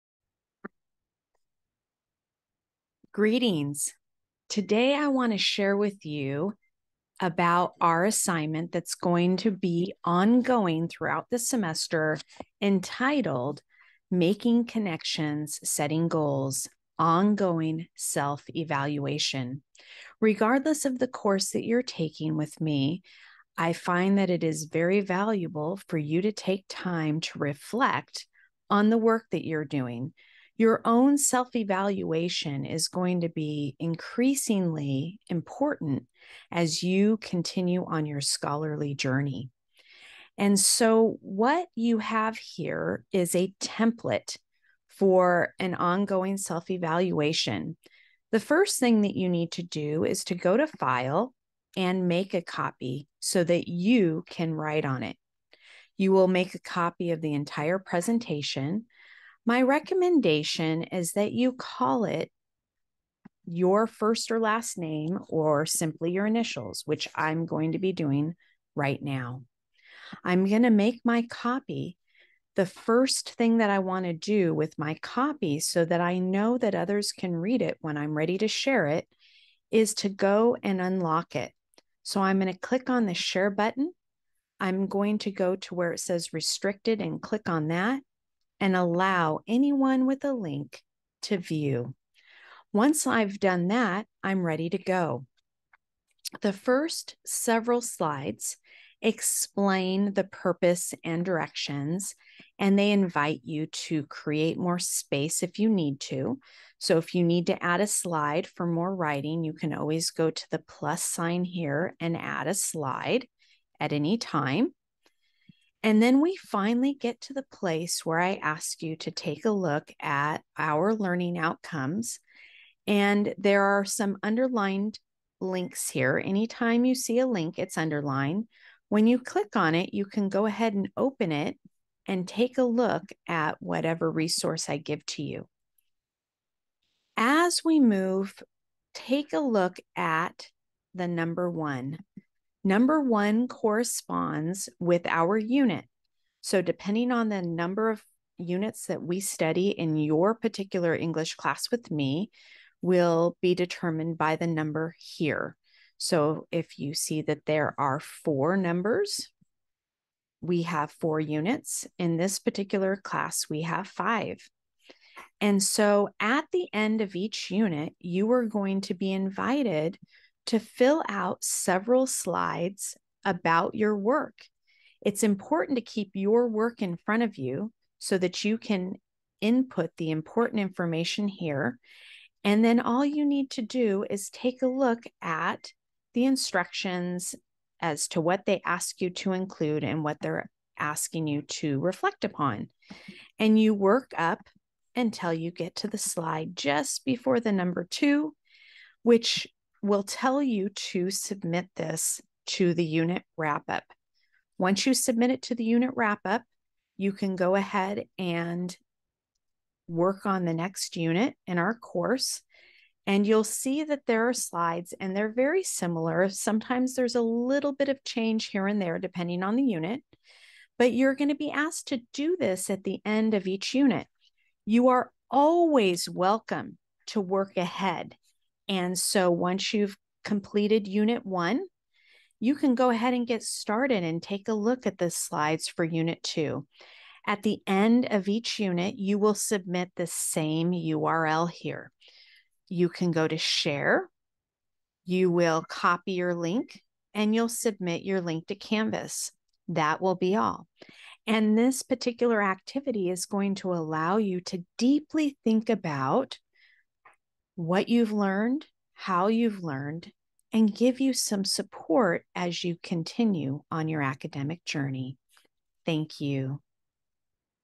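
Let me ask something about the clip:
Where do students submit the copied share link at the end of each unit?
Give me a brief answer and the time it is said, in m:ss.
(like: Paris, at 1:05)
Canvas, at 4:08.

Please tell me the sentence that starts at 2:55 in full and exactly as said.
It's important to keep your work in front of you so that you can input the important information here.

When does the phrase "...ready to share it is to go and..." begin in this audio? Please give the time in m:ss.
1:18.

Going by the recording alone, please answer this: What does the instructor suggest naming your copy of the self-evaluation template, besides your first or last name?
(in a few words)
your initials.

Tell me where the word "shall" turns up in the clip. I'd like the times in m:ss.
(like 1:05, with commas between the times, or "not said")
not said.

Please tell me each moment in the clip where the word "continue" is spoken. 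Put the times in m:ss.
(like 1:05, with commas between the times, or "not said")
0:37, 4:22.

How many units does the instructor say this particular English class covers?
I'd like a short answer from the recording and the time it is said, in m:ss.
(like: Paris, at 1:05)
5, at 2:43.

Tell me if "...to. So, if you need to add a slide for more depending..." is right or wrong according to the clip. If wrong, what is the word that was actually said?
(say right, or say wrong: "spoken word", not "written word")
wrong: "writing", not "depending".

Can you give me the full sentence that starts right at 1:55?
And then we finally get to the place where I ask you to take a look at our learning outcomes.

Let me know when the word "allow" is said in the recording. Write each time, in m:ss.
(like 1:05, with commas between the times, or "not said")
1:28, 4:13.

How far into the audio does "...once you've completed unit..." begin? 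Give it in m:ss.
3:49.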